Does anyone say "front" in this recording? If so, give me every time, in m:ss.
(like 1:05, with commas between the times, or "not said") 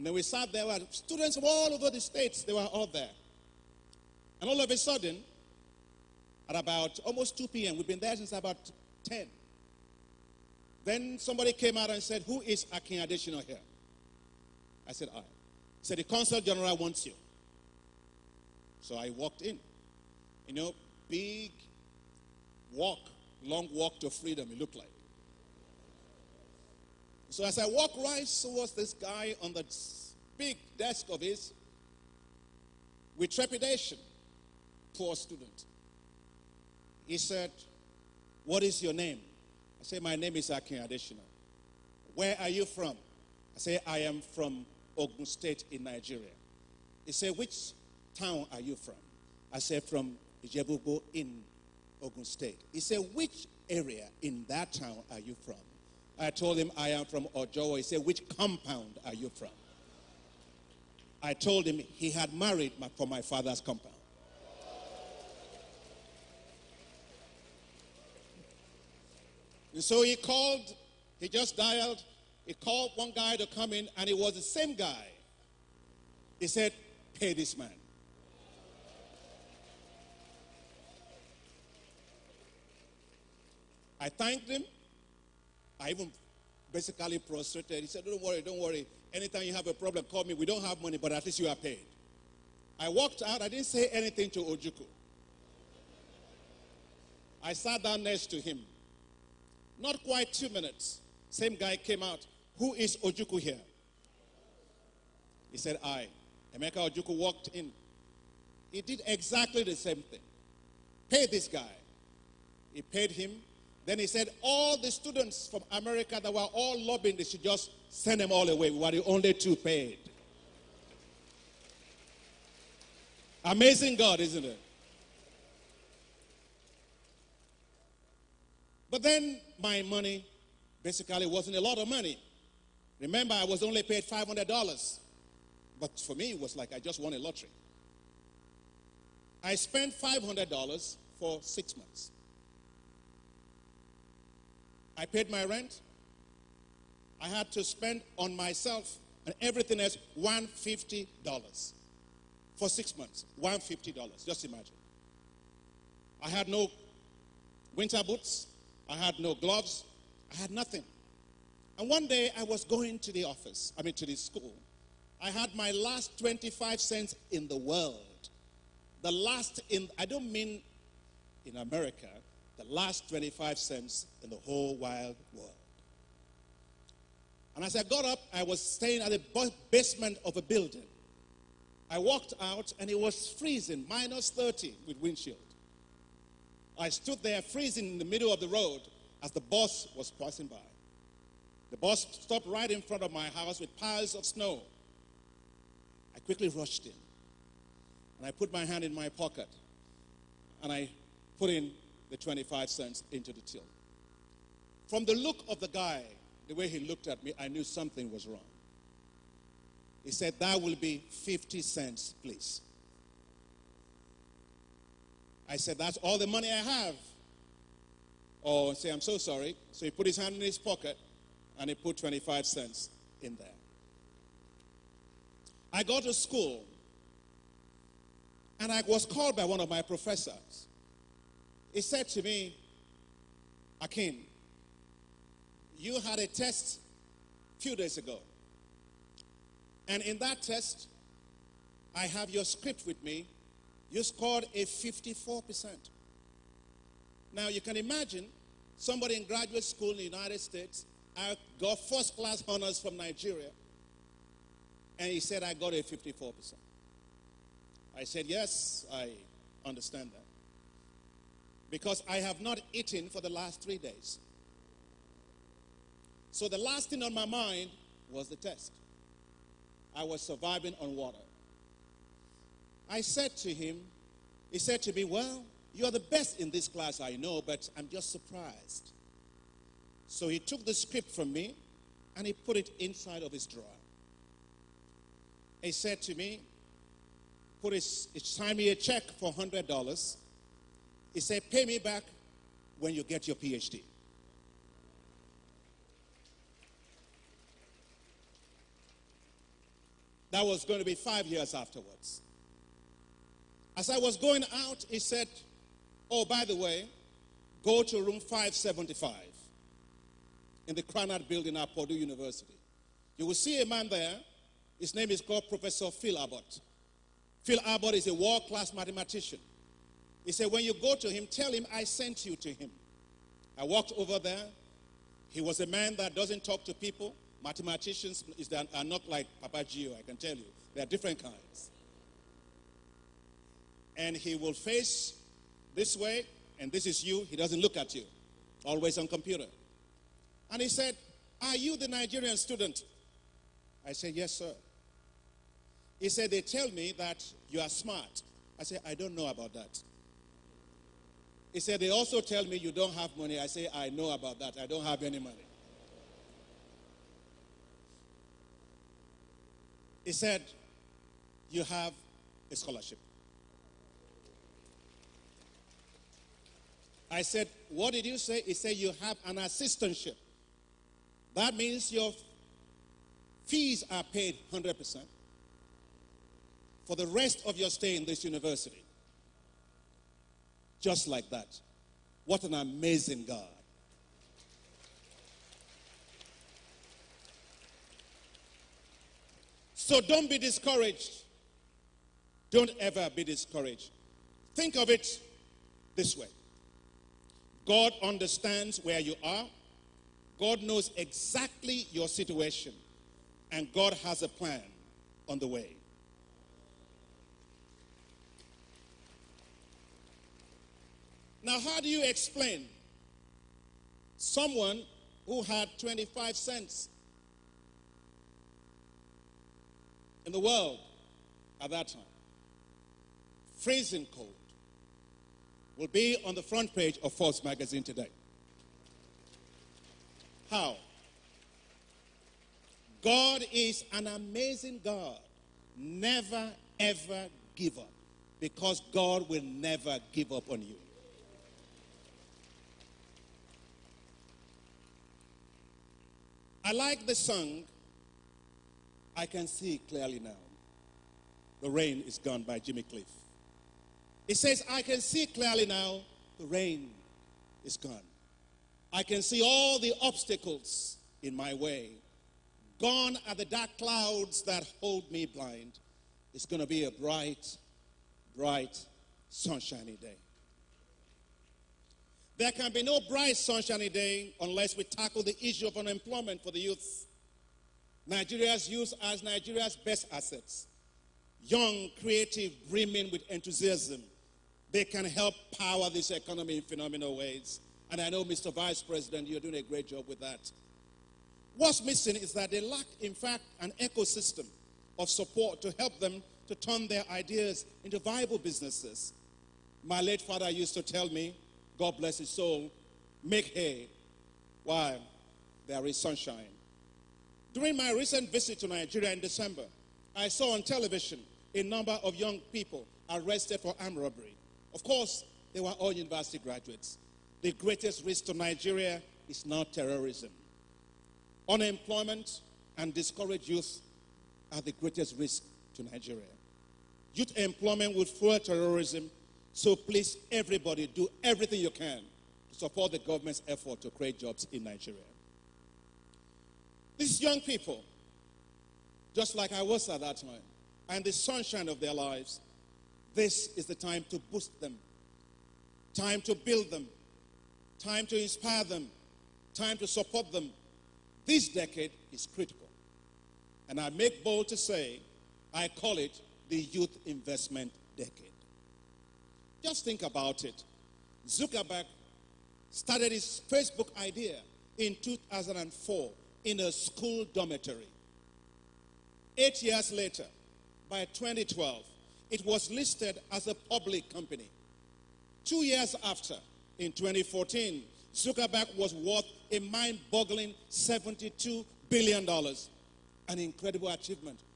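3:12, 7:06.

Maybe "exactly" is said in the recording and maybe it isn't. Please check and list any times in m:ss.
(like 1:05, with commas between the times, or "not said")
1:49, 6:40.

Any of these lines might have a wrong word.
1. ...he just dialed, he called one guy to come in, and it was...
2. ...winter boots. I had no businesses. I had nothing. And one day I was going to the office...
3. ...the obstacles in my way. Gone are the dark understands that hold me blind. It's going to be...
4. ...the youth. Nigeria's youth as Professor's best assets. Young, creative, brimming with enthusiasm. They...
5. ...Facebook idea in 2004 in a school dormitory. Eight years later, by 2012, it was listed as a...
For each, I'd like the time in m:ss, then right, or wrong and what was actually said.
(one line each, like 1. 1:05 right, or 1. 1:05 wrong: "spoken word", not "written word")
1. 1:11 right
2. 2:37 wrong: "gloves", not "businesses"
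3. 7:39 wrong: "clouds", not "understands"
4. 7:56 wrong: "Nigeria", not "Professor"
5. 9:23 right.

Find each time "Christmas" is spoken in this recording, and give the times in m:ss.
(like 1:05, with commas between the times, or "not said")
not said.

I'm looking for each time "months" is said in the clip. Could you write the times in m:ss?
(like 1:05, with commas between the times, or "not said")
2:21, 2:32.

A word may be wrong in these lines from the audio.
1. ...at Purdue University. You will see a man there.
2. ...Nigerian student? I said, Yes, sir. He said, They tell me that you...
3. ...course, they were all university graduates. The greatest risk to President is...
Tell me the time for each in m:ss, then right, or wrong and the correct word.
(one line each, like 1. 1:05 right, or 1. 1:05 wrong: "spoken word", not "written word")
1. 5:11 right
2. 5:41 right
3. 8:34 wrong: "Nigeria", not "President".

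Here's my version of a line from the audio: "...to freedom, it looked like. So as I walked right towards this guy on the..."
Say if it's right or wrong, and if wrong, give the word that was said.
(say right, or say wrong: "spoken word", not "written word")
right.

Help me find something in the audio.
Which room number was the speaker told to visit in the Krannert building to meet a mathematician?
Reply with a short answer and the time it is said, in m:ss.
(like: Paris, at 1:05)
575, at 5:08.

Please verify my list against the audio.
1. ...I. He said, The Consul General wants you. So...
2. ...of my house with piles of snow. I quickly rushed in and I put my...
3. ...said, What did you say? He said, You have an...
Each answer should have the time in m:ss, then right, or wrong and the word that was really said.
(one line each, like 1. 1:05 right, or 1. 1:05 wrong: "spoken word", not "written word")
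1. 0:15 right
2. 3:13 right
3. 6:07 right.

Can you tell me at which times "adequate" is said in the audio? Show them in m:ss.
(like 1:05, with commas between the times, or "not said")
not said.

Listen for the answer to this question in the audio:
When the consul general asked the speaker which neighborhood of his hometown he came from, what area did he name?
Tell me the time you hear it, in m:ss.
0:57.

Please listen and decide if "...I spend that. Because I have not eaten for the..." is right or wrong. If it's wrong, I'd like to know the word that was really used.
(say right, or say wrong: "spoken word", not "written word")
wrong: "understand", not "spend".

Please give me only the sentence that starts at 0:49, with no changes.
I said, From Ijebubo in Ogun State.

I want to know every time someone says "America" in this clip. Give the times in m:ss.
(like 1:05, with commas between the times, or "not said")
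1:55, 2:51.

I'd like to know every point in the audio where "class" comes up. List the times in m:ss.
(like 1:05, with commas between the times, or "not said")
4:12, 4:36, 5:18.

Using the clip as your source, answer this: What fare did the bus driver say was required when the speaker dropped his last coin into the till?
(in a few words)
50 cents.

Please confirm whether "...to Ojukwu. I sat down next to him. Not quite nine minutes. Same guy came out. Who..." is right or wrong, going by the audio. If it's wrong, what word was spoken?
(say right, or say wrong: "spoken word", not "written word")
wrong: "two", not "nine".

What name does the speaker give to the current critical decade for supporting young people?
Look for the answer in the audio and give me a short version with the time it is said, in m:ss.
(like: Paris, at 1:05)
Youth Investment Decade, at 9:16.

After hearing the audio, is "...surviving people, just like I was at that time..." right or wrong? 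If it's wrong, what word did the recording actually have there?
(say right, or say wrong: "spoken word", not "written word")
wrong: "young", not "surviving".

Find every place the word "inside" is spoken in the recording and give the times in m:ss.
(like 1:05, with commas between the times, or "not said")
4:42.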